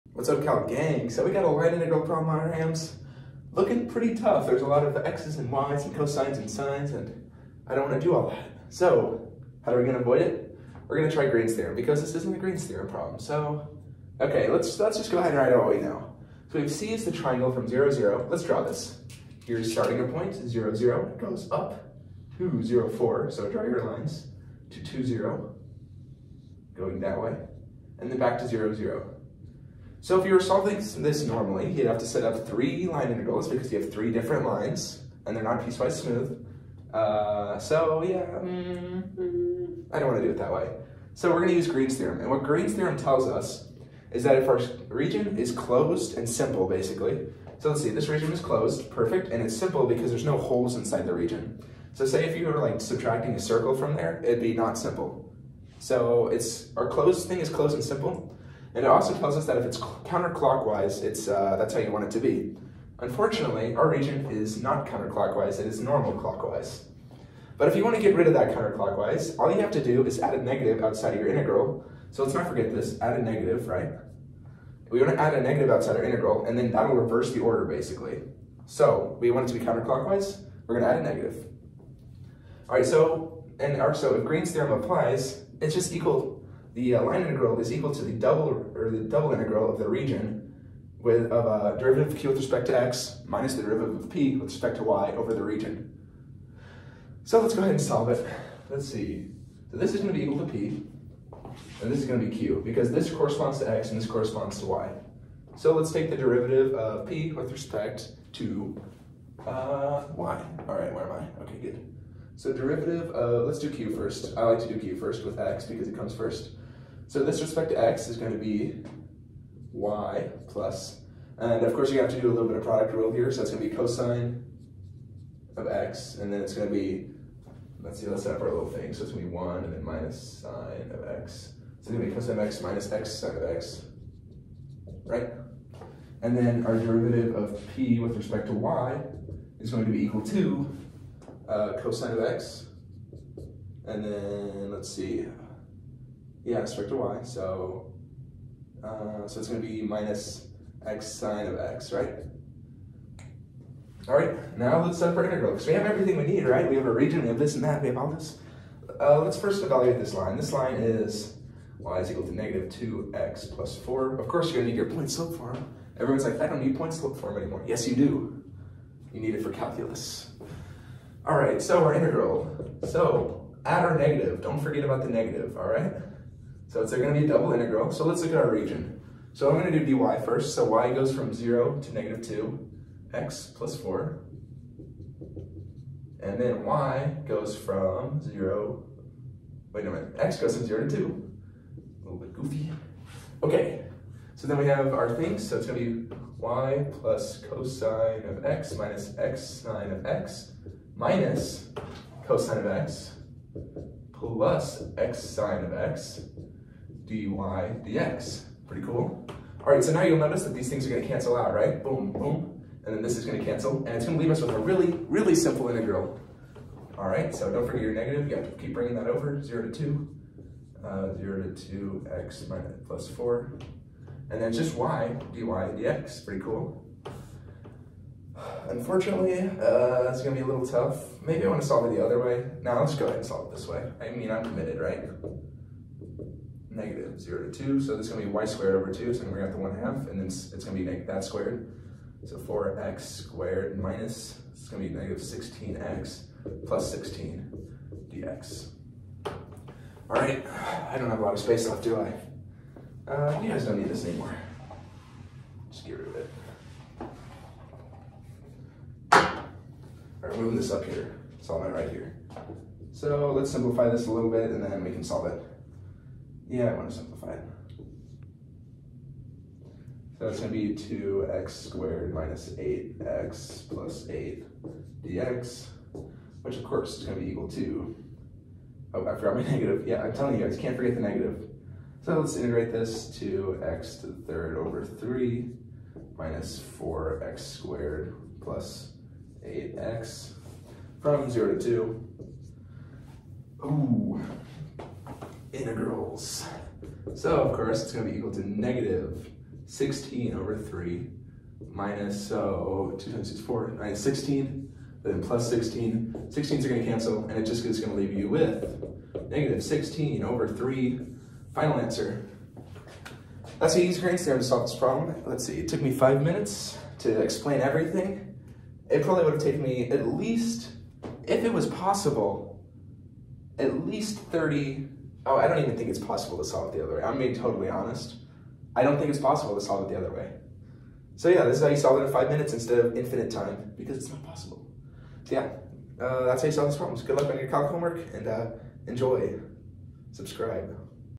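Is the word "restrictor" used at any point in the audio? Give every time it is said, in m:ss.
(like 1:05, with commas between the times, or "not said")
2:26.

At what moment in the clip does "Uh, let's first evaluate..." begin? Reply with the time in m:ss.
2:38.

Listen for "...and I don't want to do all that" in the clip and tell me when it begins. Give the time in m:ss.
0:06.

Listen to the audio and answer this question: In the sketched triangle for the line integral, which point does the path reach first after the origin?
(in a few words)
(0, 4).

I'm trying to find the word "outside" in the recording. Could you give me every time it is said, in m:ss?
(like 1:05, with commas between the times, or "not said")
1:10, 1:15.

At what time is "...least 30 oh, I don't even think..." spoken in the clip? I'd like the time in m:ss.
5:23.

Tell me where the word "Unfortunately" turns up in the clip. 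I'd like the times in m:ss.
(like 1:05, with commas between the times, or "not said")
1:02, 3:48.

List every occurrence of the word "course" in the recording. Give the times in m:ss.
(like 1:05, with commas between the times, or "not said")
2:01, 2:44, 4:36, 4:57.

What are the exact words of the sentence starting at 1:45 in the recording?
So let's take the derivative of p with respect to uh, y.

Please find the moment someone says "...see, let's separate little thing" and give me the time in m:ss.
2:07.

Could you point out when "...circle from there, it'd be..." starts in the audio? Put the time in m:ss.
0:53.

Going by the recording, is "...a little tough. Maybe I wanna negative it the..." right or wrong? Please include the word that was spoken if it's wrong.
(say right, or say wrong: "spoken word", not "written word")
wrong: "solve", not "negative".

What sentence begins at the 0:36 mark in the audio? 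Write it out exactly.
Uh, so yeah, mm, I don't want to do it that way.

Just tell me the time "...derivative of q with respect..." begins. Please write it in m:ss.
1:31.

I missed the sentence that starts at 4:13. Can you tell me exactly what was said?
Uh, you guys don't need this anymore.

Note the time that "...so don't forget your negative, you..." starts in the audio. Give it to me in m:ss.
3:37.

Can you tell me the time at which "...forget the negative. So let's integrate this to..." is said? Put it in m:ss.
4:40.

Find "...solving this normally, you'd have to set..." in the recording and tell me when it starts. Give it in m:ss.
0:30.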